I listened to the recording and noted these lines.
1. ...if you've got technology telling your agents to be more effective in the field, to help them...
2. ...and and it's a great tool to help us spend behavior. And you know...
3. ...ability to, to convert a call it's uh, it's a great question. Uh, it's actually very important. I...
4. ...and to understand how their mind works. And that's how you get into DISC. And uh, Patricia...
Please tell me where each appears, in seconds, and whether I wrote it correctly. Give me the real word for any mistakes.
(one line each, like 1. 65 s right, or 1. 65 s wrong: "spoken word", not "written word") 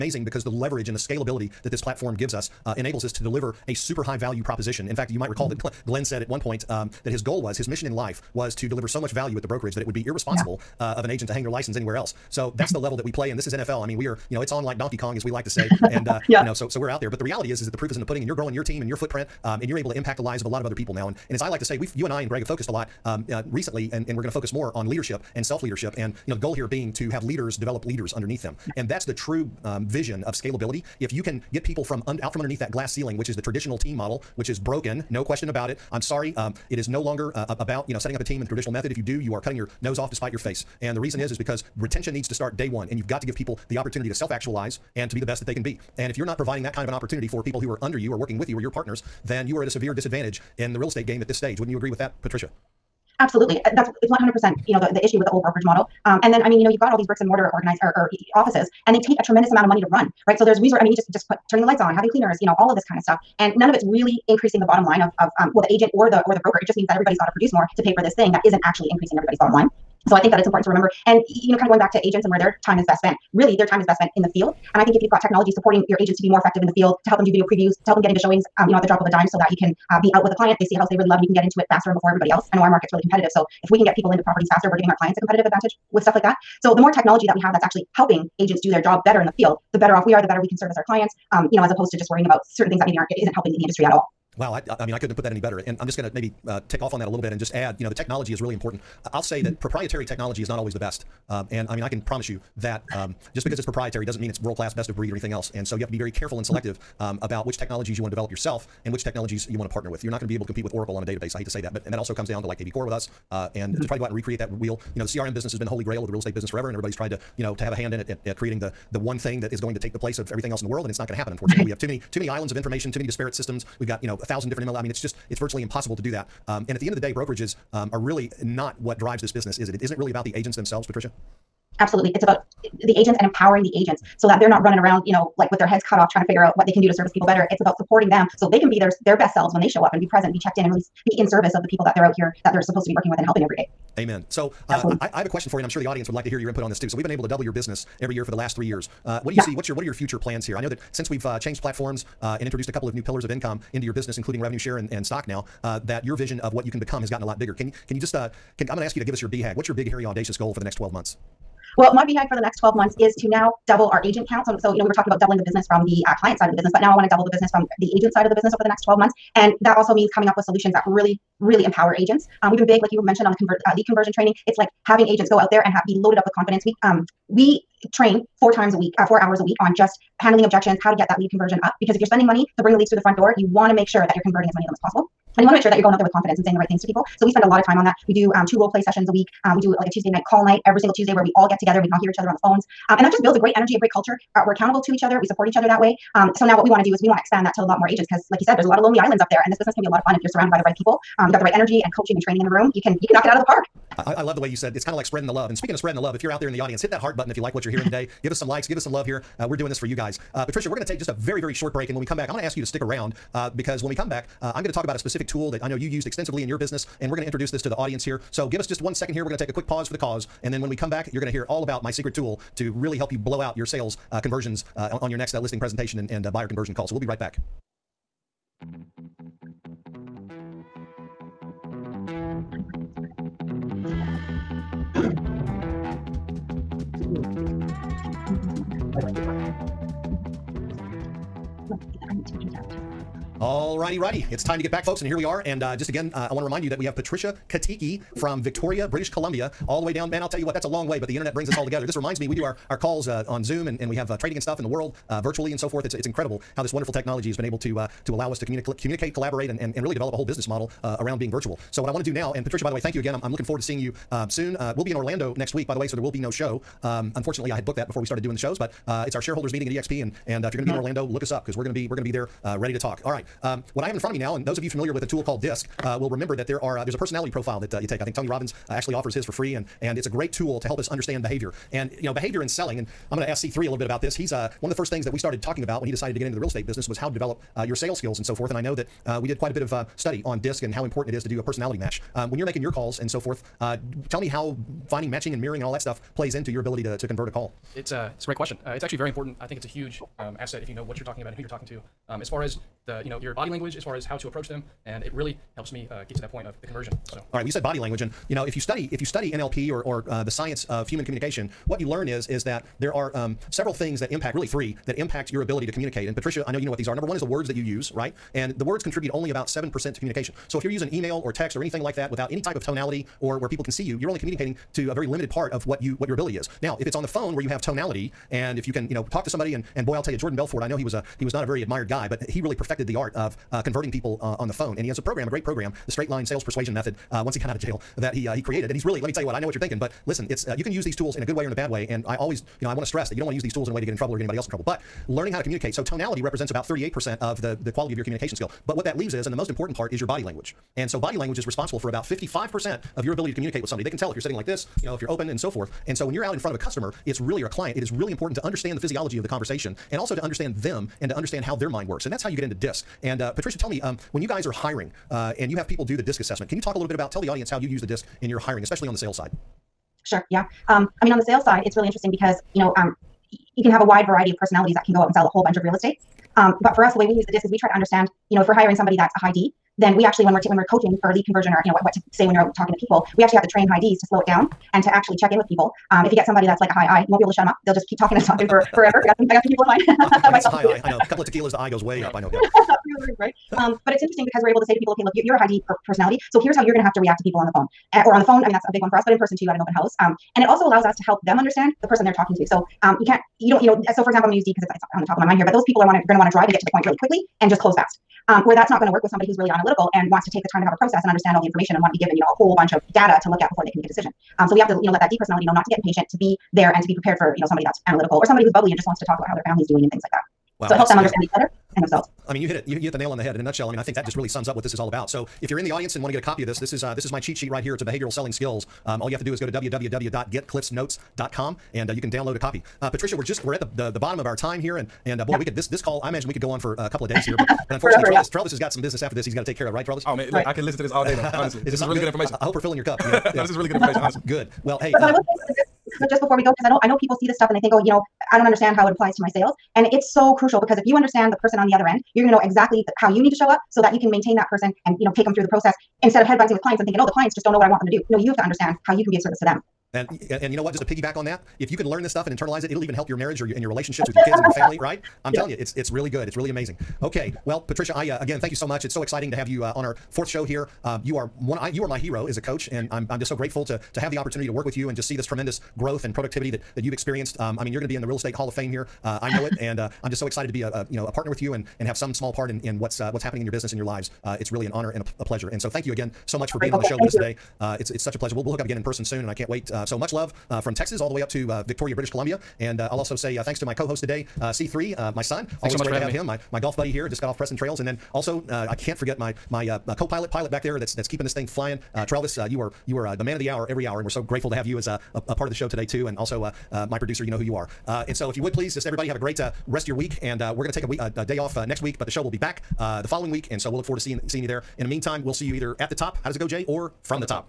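1. 74 s wrong: "supporting", not "telling"
2. 279 s wrong: "understand", not "spend"
3. 296 s right
4. 361 s right.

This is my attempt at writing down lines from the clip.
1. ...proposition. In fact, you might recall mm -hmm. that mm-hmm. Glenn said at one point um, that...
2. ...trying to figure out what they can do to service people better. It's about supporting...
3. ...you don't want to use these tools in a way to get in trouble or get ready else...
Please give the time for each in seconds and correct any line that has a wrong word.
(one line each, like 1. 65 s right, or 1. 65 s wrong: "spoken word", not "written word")
1. 4 s right
2. 136 s right
3. 343 s wrong: "anybody", not "ready".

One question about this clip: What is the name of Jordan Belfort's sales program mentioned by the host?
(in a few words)
Straight line sales persuasion method.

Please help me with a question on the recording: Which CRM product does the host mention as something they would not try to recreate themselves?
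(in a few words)
kvCORE.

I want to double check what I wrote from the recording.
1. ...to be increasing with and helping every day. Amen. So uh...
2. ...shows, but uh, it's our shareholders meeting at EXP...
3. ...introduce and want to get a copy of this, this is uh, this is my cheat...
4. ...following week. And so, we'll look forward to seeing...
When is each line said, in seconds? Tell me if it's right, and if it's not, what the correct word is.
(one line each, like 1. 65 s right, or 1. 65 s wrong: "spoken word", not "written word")
1. 142 s wrong: "working", not "increasing"
2. 268 s right
3. 425 s wrong: "audience", not "introduce"
4. 513 s right.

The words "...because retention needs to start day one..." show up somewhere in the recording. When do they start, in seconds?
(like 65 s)
41 s.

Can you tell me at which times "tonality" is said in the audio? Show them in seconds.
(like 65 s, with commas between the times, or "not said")
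322 s, 327 s, 345 s.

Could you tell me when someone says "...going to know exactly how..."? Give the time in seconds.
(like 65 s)
452 s.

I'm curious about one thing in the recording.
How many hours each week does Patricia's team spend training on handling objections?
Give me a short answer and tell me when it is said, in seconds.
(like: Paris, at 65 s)
4 hours, at 179 s.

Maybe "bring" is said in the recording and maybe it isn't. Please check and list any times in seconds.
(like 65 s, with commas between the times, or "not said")
182 s, 251 s.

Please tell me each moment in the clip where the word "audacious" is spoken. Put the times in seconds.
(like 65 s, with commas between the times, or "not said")
160 s.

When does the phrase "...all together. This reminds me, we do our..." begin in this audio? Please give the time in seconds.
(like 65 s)
251 s.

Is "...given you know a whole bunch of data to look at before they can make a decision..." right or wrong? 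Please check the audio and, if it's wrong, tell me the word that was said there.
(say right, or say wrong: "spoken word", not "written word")
right.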